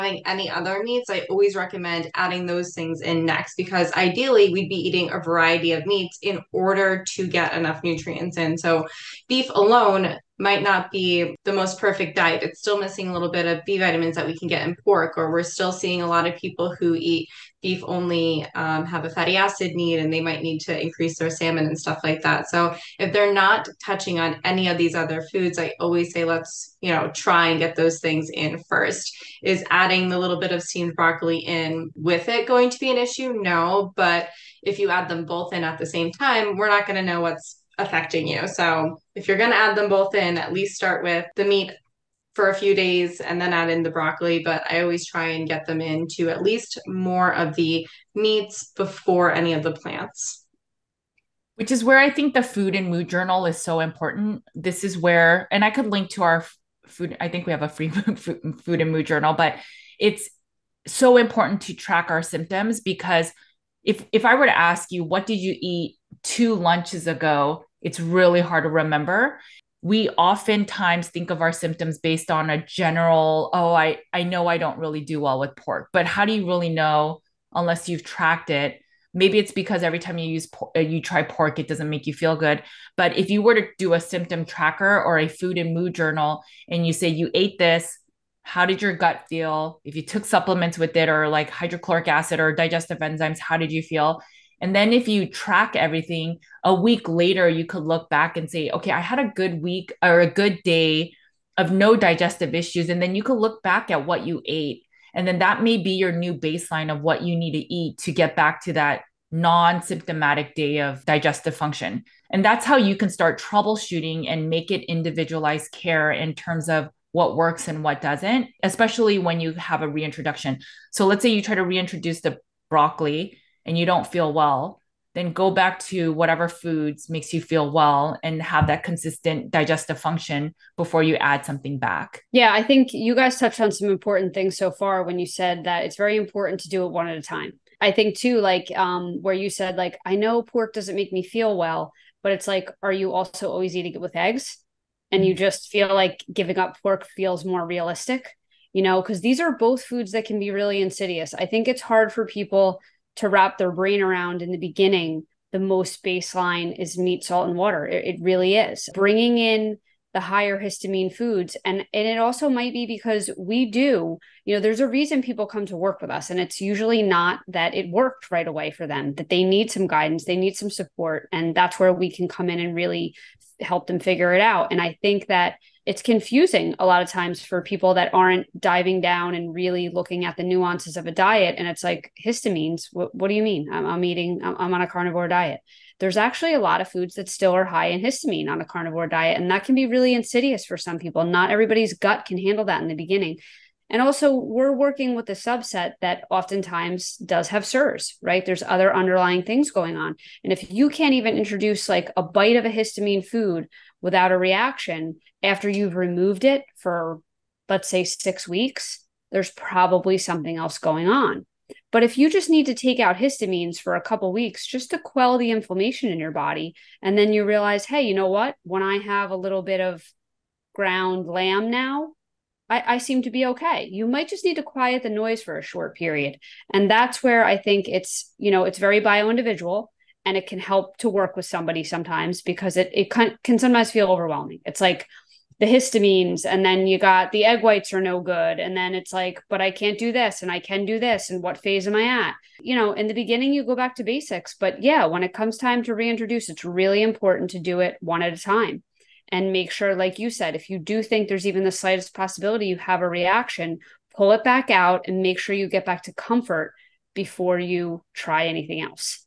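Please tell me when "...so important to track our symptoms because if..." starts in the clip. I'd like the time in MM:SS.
01:00.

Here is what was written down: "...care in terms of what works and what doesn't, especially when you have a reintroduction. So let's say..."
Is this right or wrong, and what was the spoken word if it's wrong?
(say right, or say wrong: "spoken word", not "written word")
right.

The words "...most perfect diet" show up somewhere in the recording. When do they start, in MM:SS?
00:11.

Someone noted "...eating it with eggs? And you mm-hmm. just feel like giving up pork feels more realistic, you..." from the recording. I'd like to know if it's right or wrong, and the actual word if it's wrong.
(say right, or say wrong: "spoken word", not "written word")
right.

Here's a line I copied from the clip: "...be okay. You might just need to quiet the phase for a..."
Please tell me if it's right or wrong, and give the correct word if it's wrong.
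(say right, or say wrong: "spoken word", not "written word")
wrong: "noise", not "phase".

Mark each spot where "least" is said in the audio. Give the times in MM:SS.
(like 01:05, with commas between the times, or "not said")
00:40, 00:46.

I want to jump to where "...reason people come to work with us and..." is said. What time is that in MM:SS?
02:44.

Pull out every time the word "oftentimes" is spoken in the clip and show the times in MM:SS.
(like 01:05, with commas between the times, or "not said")
01:10, 03:16.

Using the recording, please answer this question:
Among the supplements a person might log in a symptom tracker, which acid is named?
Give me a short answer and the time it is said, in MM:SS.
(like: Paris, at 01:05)
Hydrochloric acid, at 01:31.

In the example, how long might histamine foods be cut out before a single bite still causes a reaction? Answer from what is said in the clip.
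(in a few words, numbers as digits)
6 weeks.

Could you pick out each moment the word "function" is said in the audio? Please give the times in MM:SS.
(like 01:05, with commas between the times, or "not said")
01:51, 02:09.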